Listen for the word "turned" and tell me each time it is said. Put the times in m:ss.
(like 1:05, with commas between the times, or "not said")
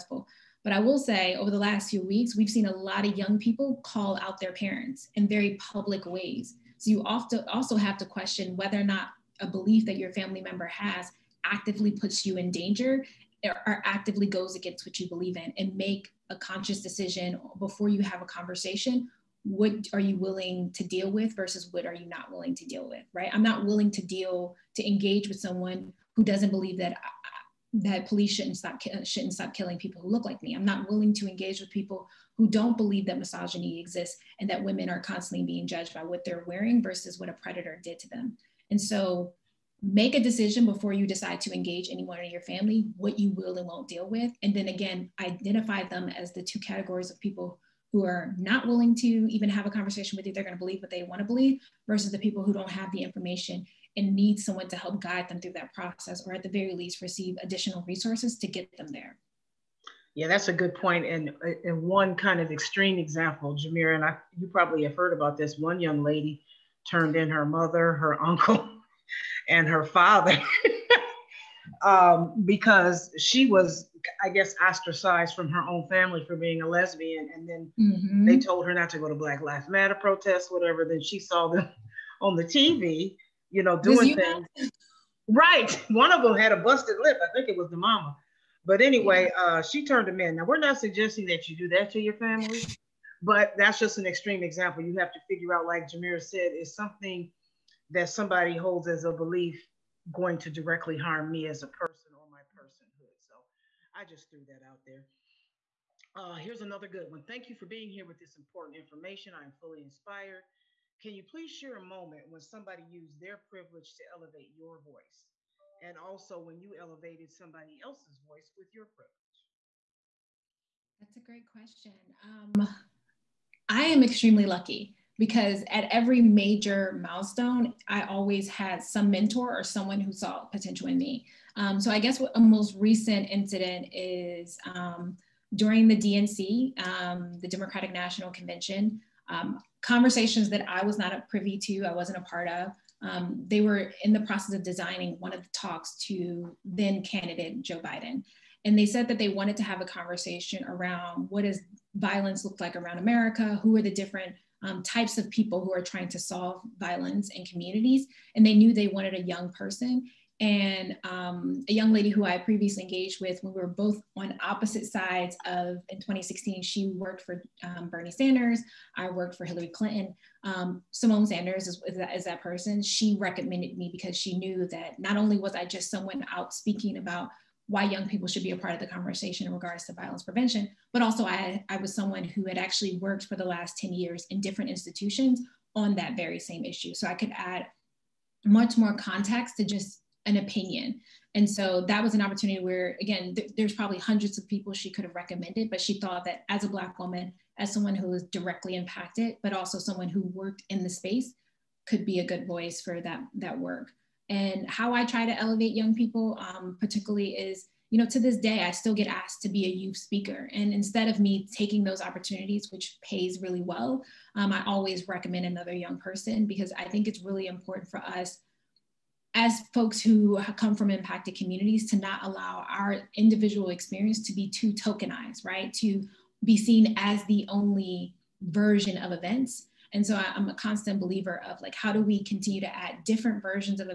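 1:06, 1:29.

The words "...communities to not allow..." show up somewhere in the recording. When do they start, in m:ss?
3:41.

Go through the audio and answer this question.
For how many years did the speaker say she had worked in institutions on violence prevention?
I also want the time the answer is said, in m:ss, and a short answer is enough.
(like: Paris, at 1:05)
10, at 3:03.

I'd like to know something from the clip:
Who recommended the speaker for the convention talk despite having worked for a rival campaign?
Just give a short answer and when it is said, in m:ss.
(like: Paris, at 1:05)
Symone Sanders, at 2:50.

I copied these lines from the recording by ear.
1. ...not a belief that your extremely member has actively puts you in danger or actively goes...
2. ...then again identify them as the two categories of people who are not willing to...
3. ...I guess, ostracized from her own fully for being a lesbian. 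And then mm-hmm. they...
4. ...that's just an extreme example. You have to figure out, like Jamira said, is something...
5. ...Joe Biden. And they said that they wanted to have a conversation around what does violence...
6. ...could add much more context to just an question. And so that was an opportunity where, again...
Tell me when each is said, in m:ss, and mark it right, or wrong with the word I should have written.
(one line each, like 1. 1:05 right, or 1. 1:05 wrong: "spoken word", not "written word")
1. 0:08 wrong: "family", not "extremely"
2. 0:44 right
3. 1:14 wrong: "family", not "fully"
4. 1:33 right
5. 2:27 right
6. 3:07 wrong: "opinion", not "question".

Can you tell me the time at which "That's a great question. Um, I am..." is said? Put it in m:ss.
2:00.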